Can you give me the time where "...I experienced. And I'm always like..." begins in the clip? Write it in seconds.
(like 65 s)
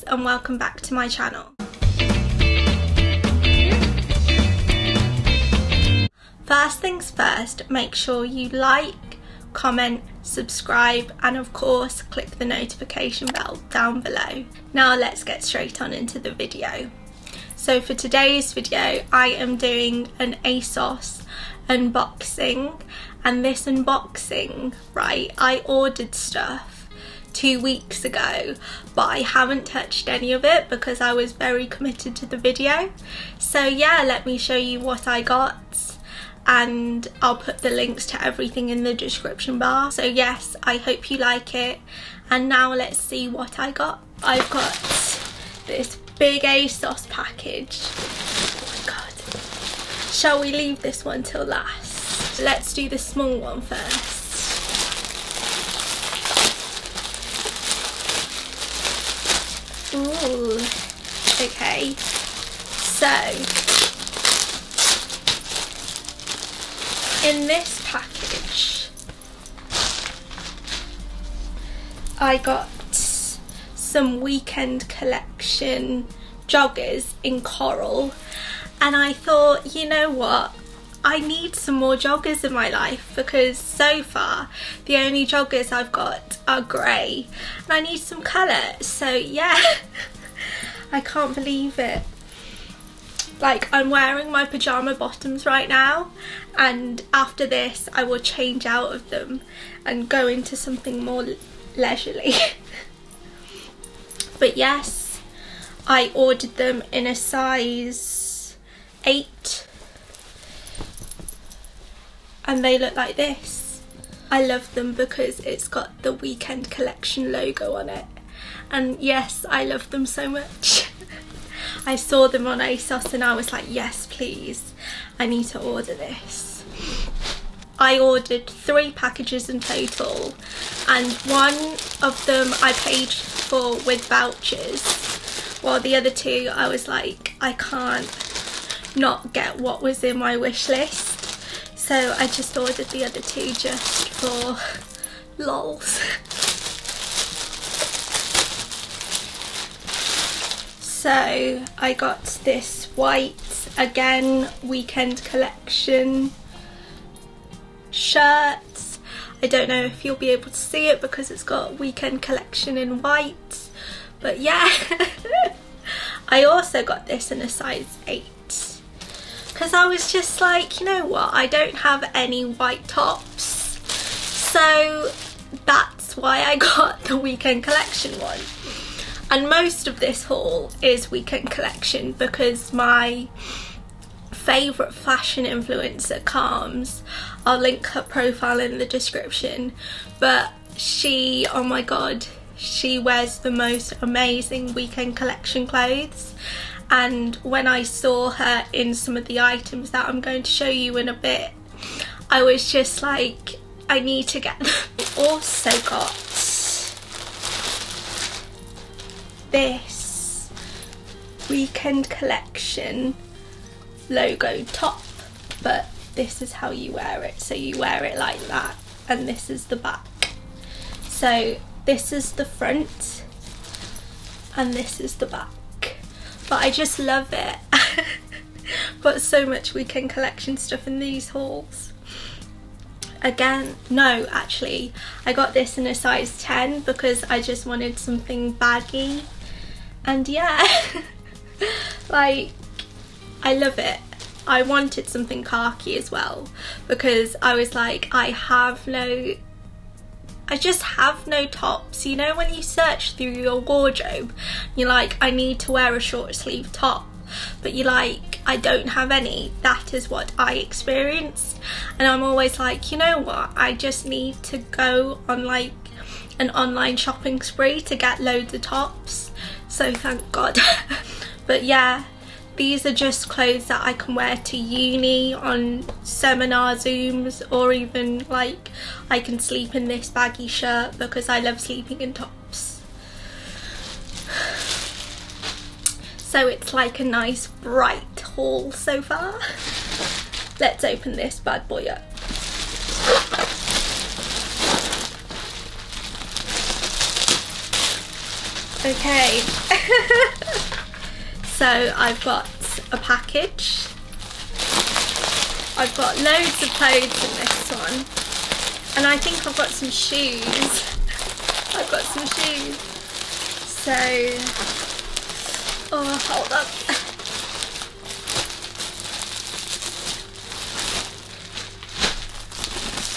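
260 s.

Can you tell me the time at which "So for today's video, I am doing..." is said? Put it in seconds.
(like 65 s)
17 s.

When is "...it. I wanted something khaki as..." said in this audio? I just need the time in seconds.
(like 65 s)
243 s.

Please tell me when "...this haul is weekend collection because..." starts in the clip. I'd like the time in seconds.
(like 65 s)
179 s.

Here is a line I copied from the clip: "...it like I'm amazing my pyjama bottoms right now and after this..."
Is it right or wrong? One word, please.
wrong.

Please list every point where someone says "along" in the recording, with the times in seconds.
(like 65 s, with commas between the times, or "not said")
not said.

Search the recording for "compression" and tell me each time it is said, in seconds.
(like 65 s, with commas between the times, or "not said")
not said.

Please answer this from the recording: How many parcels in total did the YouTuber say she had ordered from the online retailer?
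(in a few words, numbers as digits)
3.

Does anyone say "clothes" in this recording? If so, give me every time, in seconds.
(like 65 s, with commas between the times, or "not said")
195 s, 273 s, 306 s.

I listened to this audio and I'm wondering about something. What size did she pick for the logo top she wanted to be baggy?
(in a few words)
10.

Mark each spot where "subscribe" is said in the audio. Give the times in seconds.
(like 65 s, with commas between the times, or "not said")
10 s.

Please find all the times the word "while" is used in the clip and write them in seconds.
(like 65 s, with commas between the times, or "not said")
135 s.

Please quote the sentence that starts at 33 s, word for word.
So yeah, let me show you what I got and I'll put the links to everything in the description bar.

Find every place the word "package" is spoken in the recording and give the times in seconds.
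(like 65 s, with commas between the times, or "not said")
47 s, 67 s, 128 s, 302 s.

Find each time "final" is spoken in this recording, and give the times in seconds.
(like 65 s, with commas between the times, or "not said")
not said.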